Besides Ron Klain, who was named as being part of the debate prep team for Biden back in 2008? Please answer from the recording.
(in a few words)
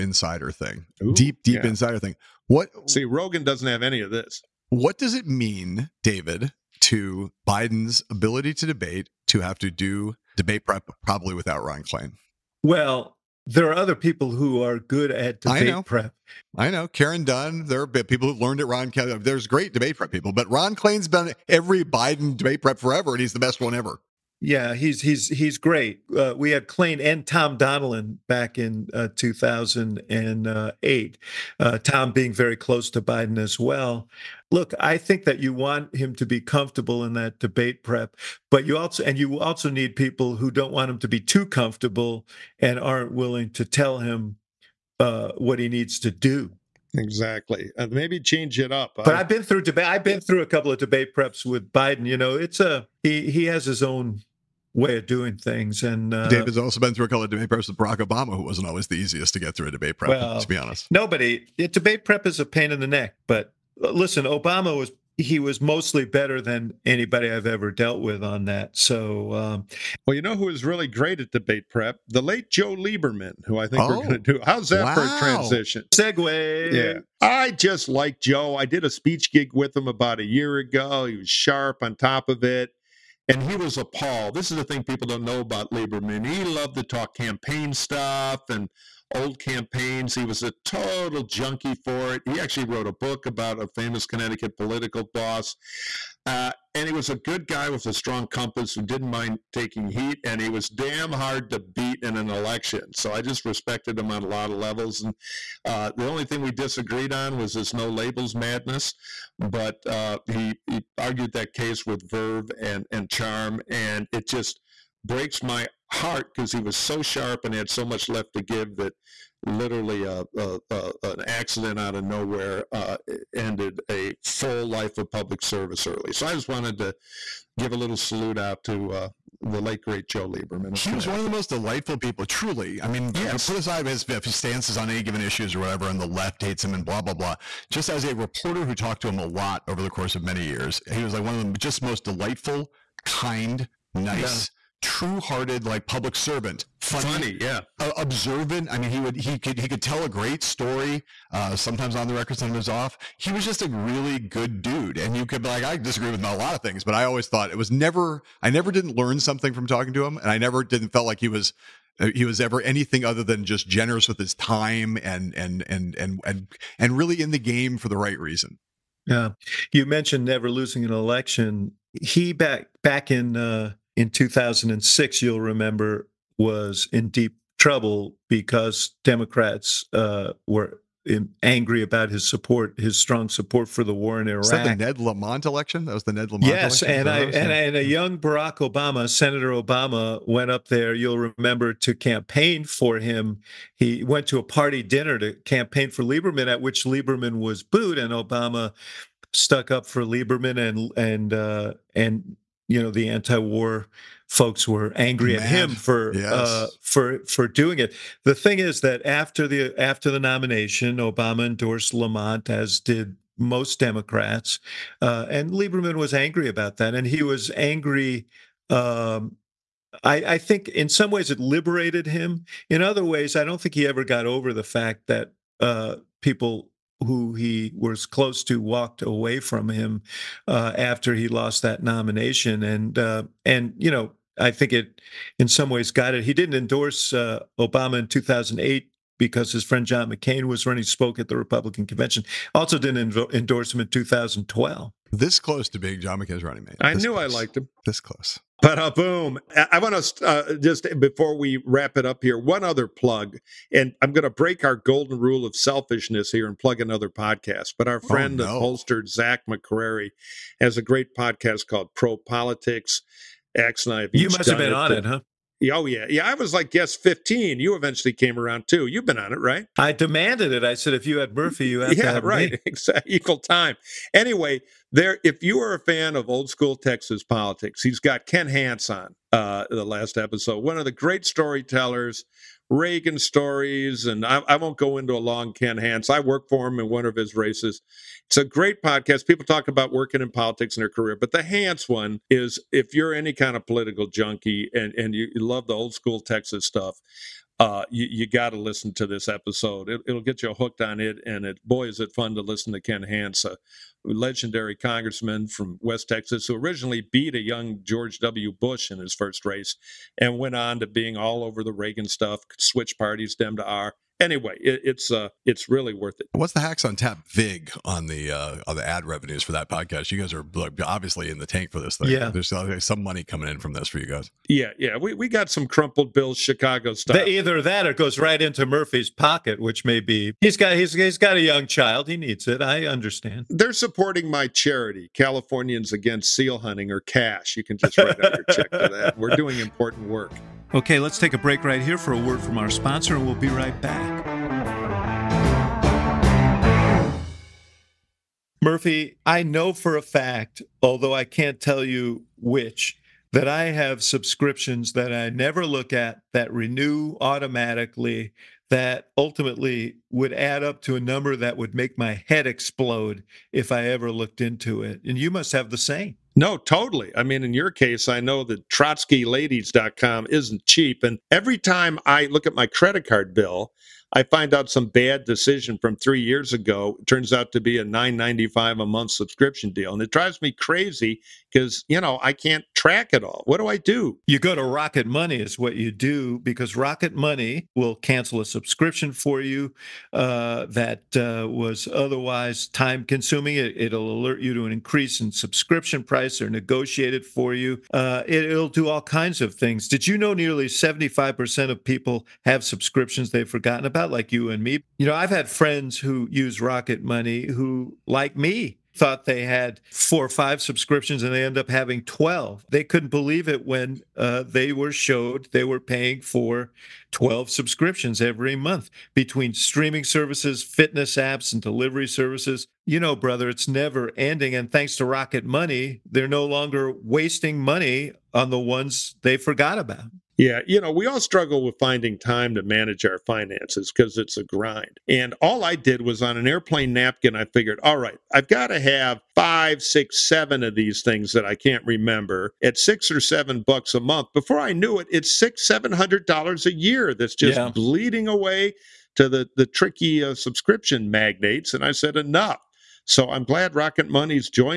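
Tom Donilon.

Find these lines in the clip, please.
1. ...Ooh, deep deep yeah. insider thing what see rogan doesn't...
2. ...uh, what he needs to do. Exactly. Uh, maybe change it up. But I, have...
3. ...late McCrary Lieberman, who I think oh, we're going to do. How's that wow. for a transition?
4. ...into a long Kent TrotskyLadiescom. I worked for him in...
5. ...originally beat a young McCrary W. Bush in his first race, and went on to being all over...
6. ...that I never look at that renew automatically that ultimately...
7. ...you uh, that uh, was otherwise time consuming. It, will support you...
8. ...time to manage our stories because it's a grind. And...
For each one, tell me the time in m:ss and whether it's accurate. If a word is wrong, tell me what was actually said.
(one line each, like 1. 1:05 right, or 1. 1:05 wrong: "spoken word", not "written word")
1. 0:01 right
2. 0:44 right
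3. 1:12 wrong: "Joe", not "McCrary"
4. 4:44 wrong: "Hance", not "TrotskyLadiescom"
5. 5:06 wrong: "George", not "McCrary"
6. 5:54 right
7. 6:29 wrong: "alert", not "support"
8. 7:12 wrong: "finances", not "stories".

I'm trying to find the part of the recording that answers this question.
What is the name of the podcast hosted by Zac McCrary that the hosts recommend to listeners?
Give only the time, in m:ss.
4:21.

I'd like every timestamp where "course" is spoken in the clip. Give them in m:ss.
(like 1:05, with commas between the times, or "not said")
2:19.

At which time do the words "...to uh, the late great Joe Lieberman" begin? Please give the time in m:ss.
2:08.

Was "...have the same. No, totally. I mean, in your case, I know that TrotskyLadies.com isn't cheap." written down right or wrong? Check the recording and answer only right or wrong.
right.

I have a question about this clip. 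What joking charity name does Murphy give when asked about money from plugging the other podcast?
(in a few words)
Californians Against Seal Hunting.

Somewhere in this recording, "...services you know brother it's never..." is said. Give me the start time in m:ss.
7:02.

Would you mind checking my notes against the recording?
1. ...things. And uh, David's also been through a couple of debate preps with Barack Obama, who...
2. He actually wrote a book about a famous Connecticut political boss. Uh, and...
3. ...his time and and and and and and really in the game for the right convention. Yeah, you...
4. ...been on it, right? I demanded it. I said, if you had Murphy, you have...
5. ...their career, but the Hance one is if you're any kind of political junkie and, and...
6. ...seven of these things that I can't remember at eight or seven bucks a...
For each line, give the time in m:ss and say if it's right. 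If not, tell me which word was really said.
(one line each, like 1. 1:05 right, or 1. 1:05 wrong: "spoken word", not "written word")
1. 0:55 right
2. 1:32 right
3. 2:44 wrong: "reason", not "convention"
4. 4:29 right
5. 4:50 right
6. 7:20 wrong: "six", not "eight".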